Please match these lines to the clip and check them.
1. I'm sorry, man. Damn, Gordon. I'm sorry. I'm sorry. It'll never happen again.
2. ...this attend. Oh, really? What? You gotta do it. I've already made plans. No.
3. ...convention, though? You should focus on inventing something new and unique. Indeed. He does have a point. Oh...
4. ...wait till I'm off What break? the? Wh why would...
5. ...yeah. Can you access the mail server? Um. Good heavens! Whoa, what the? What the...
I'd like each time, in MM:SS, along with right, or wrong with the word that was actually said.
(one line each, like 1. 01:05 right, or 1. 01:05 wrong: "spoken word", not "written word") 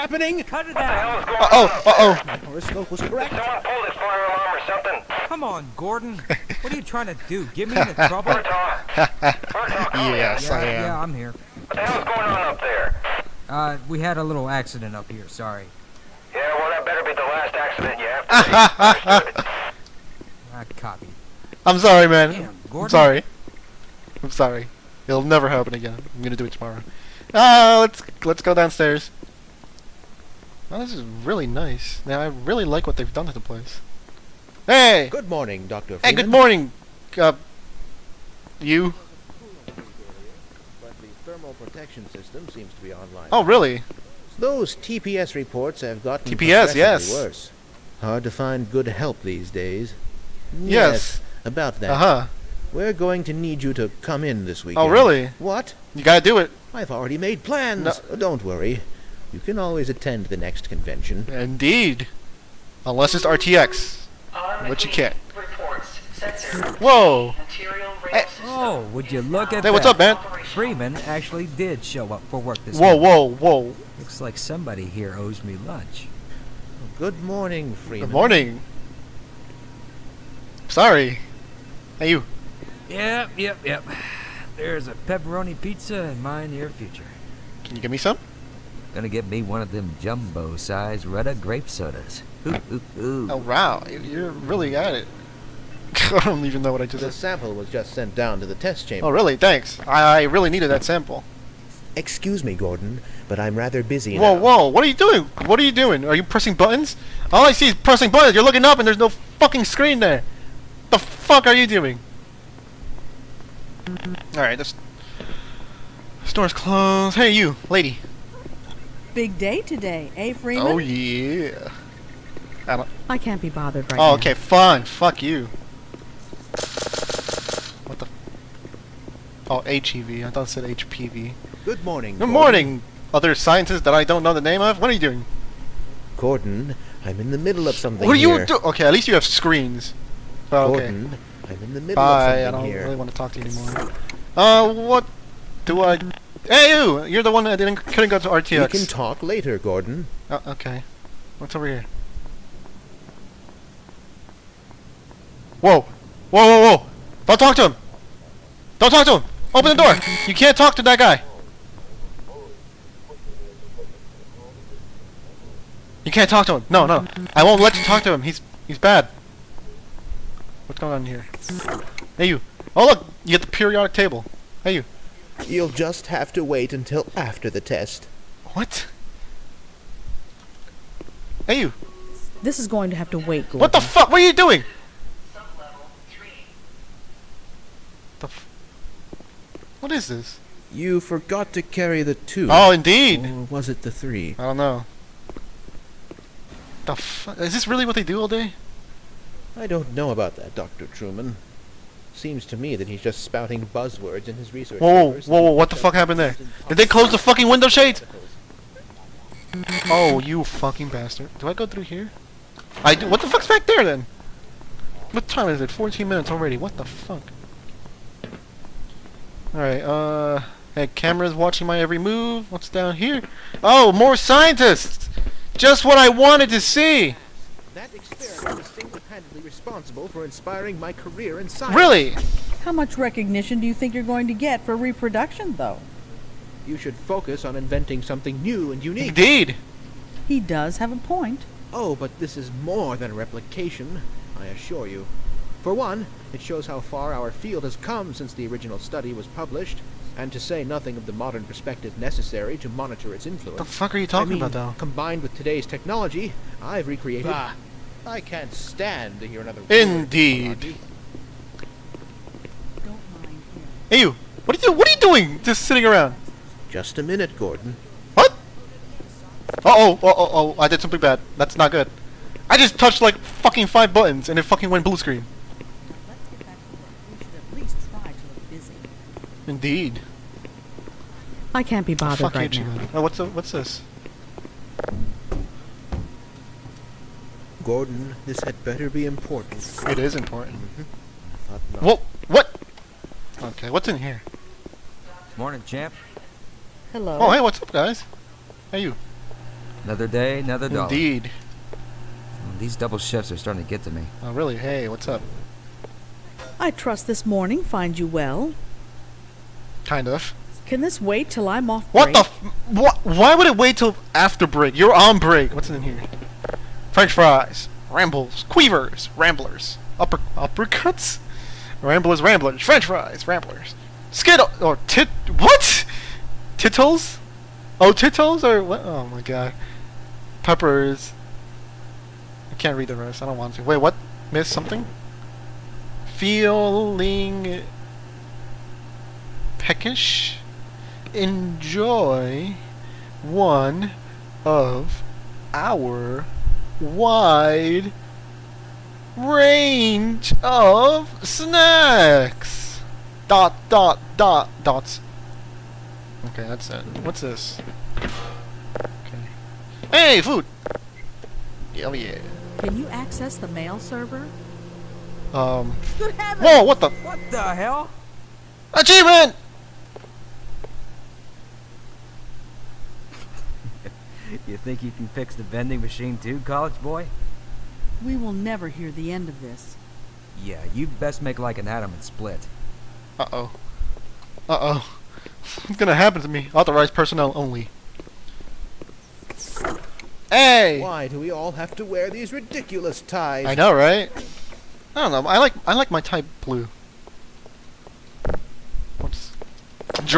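1. 00:21 right
2. 00:54 wrong: "weekend", not "attend"
3. 03:54 wrong: "reproduction", not "convention"
4. 05:11 right
5. 06:01 right.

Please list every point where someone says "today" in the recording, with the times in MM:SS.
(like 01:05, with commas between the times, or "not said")
01:59, 04:15.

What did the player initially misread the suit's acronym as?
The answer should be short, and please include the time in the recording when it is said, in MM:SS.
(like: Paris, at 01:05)
HPV, at 02:10.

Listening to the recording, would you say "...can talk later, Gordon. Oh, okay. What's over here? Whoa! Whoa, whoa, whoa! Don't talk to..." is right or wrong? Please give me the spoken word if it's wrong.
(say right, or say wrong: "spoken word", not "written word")
right.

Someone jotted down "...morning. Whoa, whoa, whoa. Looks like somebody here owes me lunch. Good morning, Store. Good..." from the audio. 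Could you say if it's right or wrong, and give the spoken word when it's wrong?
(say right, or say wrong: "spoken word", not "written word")
wrong: "Freeman", not "Store".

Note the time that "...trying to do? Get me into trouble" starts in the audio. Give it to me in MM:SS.
00:06.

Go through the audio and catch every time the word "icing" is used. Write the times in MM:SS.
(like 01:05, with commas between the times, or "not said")
not said.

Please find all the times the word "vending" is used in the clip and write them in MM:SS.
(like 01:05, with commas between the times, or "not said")
06:15.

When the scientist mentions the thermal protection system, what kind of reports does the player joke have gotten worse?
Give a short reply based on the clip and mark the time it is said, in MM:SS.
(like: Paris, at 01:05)
TPS reports, at 00:44.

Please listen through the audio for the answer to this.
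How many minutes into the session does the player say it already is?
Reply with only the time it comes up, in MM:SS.
03:35.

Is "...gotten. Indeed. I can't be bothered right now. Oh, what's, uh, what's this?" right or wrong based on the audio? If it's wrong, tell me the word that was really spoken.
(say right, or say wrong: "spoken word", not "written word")
wrong: "screen", not "gotten".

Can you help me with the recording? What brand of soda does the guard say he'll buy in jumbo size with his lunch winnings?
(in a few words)
Retta grape.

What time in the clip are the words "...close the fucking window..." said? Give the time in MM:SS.
03:26.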